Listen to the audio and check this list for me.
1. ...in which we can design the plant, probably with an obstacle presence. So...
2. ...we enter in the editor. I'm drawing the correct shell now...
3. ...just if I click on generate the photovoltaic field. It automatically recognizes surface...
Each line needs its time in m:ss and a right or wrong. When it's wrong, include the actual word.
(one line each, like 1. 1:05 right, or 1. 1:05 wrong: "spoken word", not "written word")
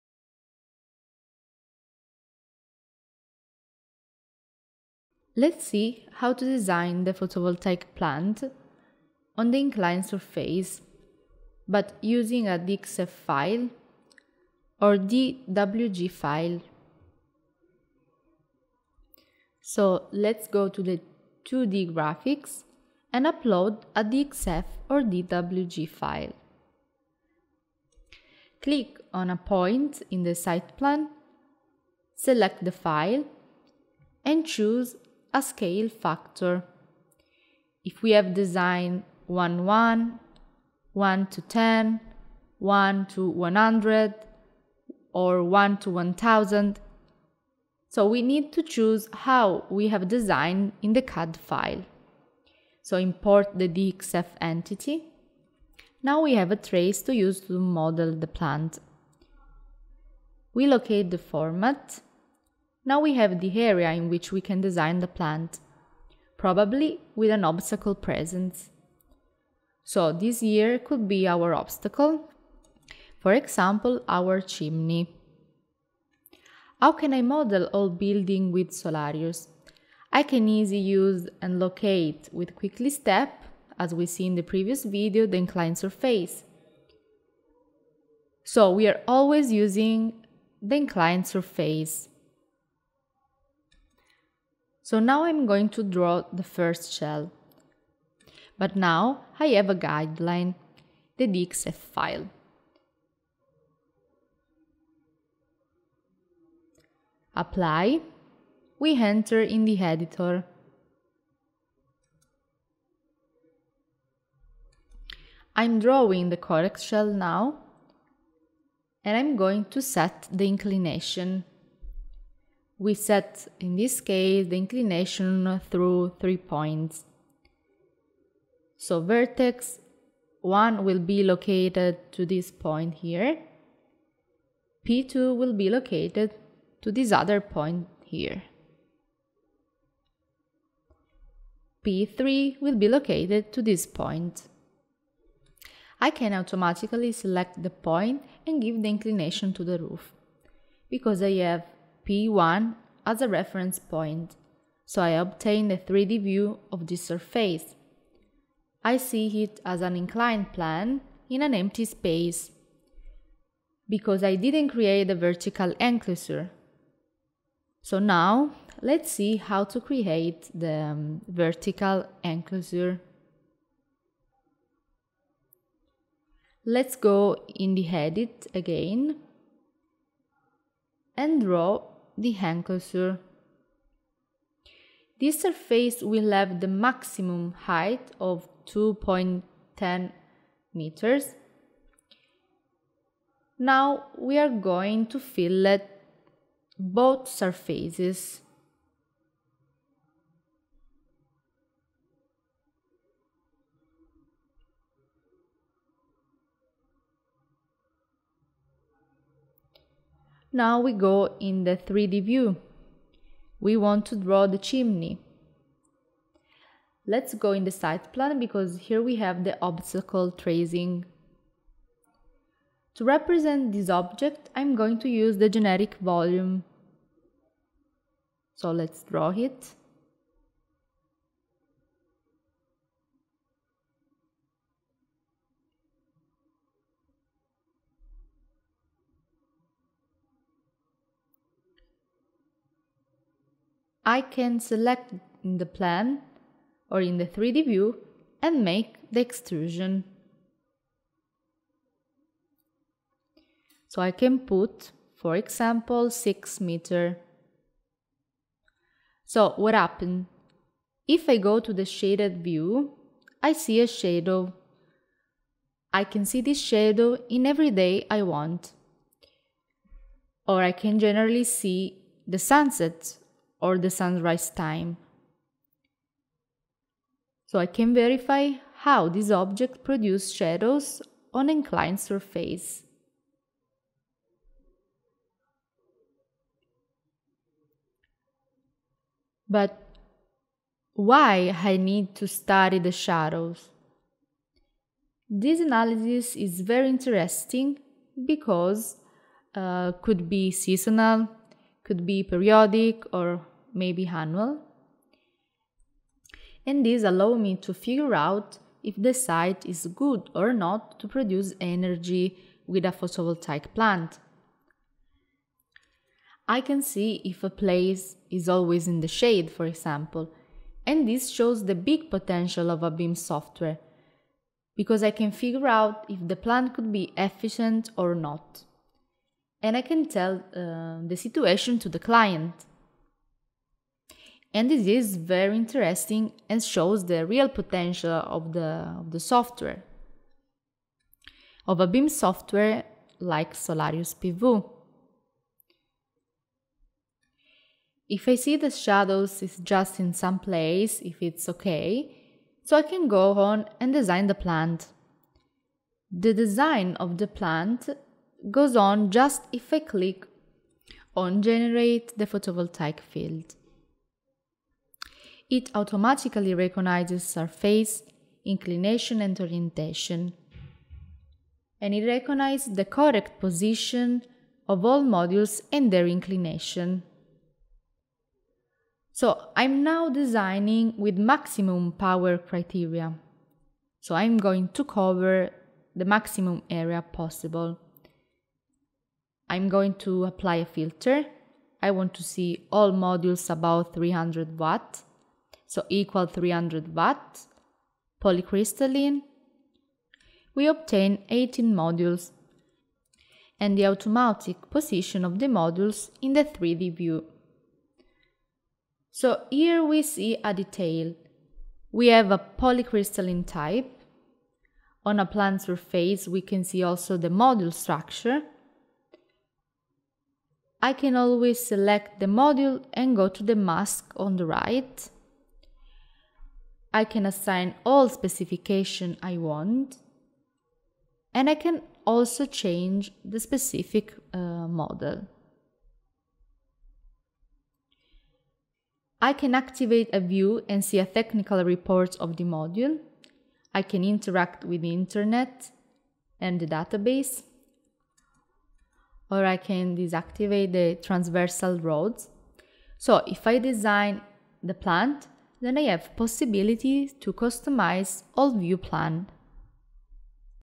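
1. 1:03 right
2. 1:48 right
3. 5:59 right.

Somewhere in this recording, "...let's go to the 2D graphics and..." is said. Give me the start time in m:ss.
0:20.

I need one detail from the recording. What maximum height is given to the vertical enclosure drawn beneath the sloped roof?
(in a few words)
2.10 meters.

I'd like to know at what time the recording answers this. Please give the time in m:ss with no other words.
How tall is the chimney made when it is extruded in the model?
4:16.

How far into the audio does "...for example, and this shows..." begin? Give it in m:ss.
5:19.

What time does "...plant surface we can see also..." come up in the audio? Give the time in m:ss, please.
6:55.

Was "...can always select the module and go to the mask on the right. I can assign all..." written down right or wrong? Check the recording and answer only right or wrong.
right.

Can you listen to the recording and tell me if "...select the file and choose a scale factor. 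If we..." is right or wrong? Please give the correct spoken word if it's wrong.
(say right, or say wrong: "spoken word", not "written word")
right.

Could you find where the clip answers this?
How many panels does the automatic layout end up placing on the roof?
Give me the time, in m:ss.
6:41.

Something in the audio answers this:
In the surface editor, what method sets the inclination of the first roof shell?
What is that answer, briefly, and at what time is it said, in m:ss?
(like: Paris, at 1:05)
Three points, at 2:05.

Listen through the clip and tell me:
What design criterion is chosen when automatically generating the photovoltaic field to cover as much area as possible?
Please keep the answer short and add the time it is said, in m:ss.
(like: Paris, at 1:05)
Maximum power, at 6:21.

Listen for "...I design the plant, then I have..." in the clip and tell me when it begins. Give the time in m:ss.
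7:33.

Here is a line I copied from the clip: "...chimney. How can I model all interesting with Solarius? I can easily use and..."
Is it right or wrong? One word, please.
wrong.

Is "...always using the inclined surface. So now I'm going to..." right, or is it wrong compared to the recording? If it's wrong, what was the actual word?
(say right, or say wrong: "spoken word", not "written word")
right.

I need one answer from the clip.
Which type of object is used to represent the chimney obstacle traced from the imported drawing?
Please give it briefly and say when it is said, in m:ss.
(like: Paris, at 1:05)
Generic volume, at 3:45.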